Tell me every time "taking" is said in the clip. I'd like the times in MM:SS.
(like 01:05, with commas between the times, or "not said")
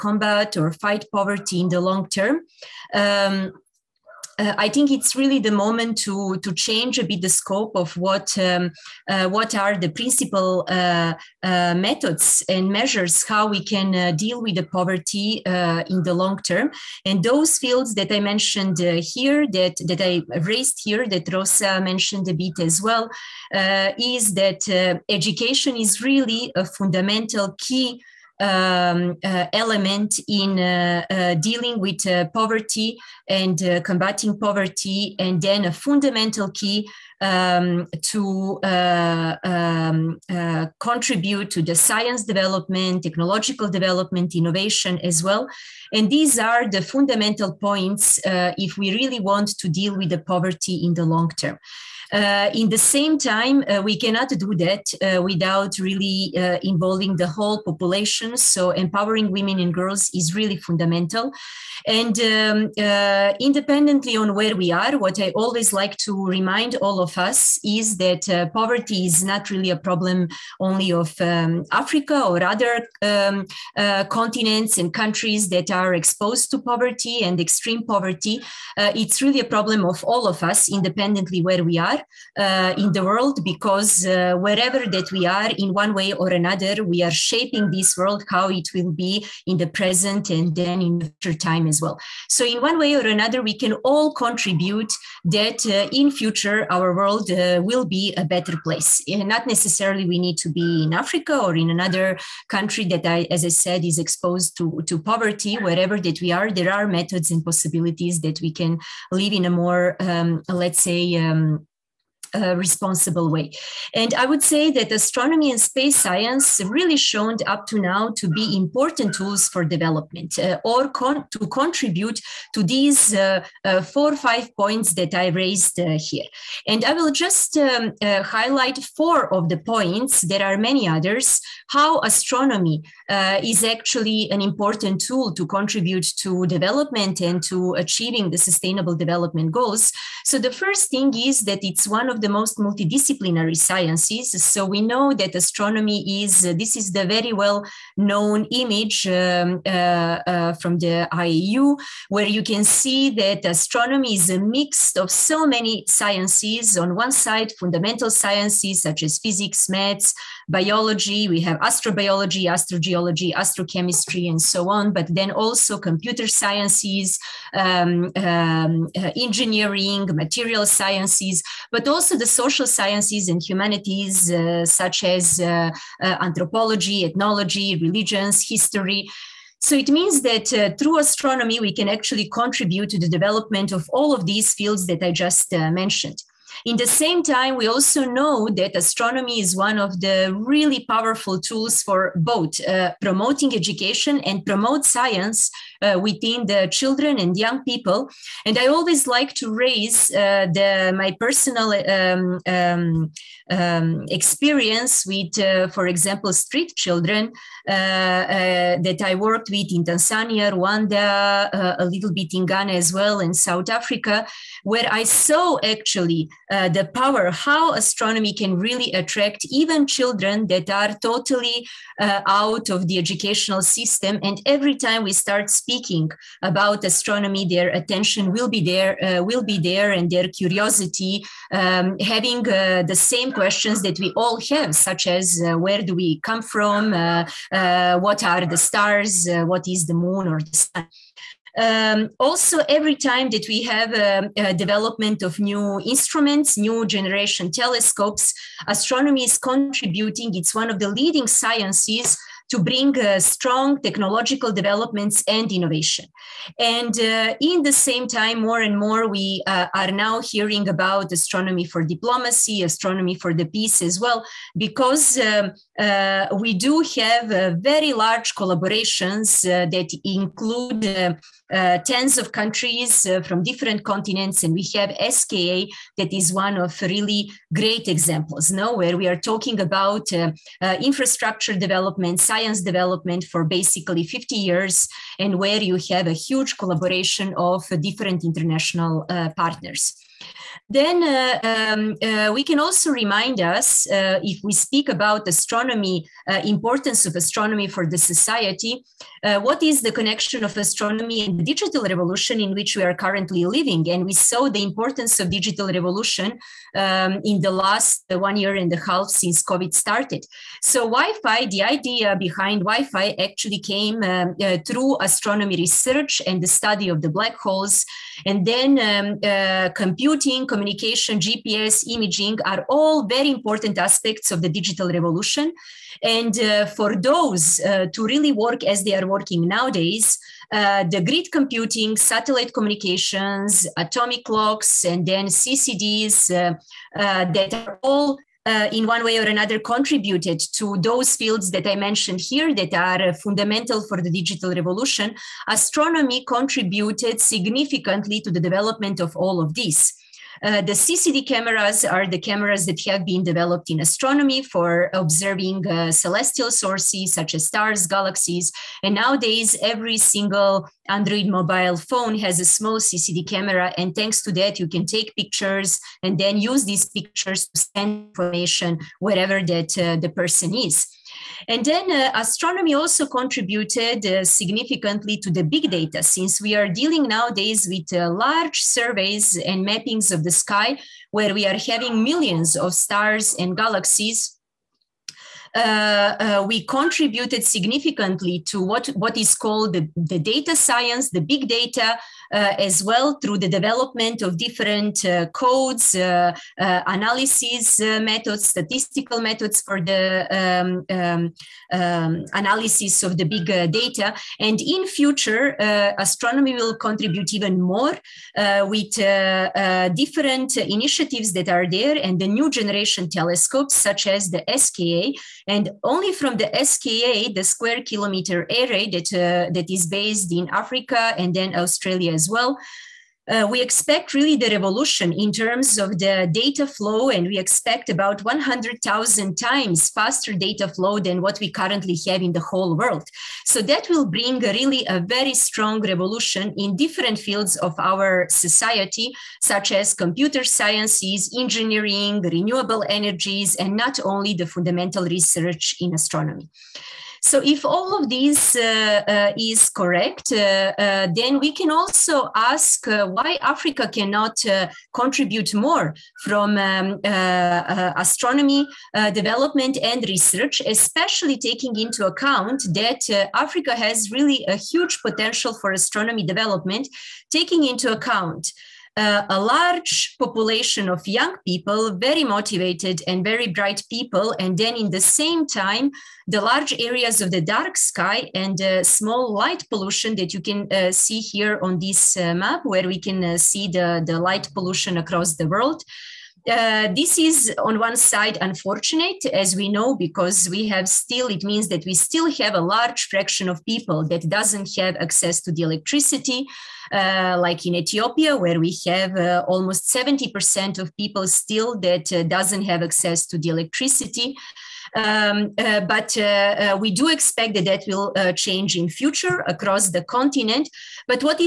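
07:41, 07:47.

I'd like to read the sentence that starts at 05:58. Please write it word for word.
And nowadays, every single Android mobile phone has a small CCD camera.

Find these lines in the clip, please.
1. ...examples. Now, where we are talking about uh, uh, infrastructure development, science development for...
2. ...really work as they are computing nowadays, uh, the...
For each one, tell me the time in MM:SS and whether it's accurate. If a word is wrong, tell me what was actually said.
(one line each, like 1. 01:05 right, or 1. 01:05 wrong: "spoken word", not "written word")
1. 04:37 right
2. 05:28 wrong: "working", not "computing".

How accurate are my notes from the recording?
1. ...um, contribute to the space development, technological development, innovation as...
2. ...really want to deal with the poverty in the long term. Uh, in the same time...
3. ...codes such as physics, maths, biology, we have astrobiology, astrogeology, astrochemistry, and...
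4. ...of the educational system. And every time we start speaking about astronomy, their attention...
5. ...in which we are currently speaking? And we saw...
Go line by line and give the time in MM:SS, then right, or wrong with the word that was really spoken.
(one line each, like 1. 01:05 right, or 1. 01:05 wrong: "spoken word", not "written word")
1. 00:38 wrong: "science", not "space"
2. 00:48 right
3. 02:38 wrong: "sciences", not "codes"
4. 03:42 right
5. 05:02 wrong: "living", not "speaking".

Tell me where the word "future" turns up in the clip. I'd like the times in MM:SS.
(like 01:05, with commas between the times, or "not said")
01:31, 01:36, 06:44, 08:28.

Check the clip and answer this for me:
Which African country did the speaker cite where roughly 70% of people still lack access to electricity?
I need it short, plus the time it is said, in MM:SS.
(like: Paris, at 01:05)
Ethiopia, at 08:17.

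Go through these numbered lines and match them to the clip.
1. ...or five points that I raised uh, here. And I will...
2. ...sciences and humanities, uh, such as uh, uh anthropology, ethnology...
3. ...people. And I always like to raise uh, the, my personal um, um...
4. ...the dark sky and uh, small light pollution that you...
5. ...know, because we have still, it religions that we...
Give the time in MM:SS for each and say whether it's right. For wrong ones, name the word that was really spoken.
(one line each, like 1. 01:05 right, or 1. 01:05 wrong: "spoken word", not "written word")
1. 02:04 right
2. 02:52 right
3. 03:17 right
4. 07:57 right
5. 08:09 wrong: "means", not "religions".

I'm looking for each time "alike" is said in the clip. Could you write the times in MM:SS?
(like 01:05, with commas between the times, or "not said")
not said.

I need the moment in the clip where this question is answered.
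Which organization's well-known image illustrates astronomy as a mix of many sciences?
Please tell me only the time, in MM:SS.
02:31.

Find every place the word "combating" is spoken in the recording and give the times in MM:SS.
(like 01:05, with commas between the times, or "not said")
00:33.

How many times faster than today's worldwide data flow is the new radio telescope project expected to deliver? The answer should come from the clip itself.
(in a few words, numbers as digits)
100,000 times.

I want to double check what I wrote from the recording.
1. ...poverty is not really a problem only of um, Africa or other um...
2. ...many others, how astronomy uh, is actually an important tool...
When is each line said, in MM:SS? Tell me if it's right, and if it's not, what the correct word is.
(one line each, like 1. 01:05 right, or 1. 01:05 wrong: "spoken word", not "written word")
1. 01:08 right
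2. 02:10 right.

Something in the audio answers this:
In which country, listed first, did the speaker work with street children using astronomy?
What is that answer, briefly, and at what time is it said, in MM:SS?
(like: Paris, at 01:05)
Tanzania, at 03:29.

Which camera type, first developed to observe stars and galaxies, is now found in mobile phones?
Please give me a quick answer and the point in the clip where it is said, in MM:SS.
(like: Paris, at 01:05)
CCD cameras, at 05:50.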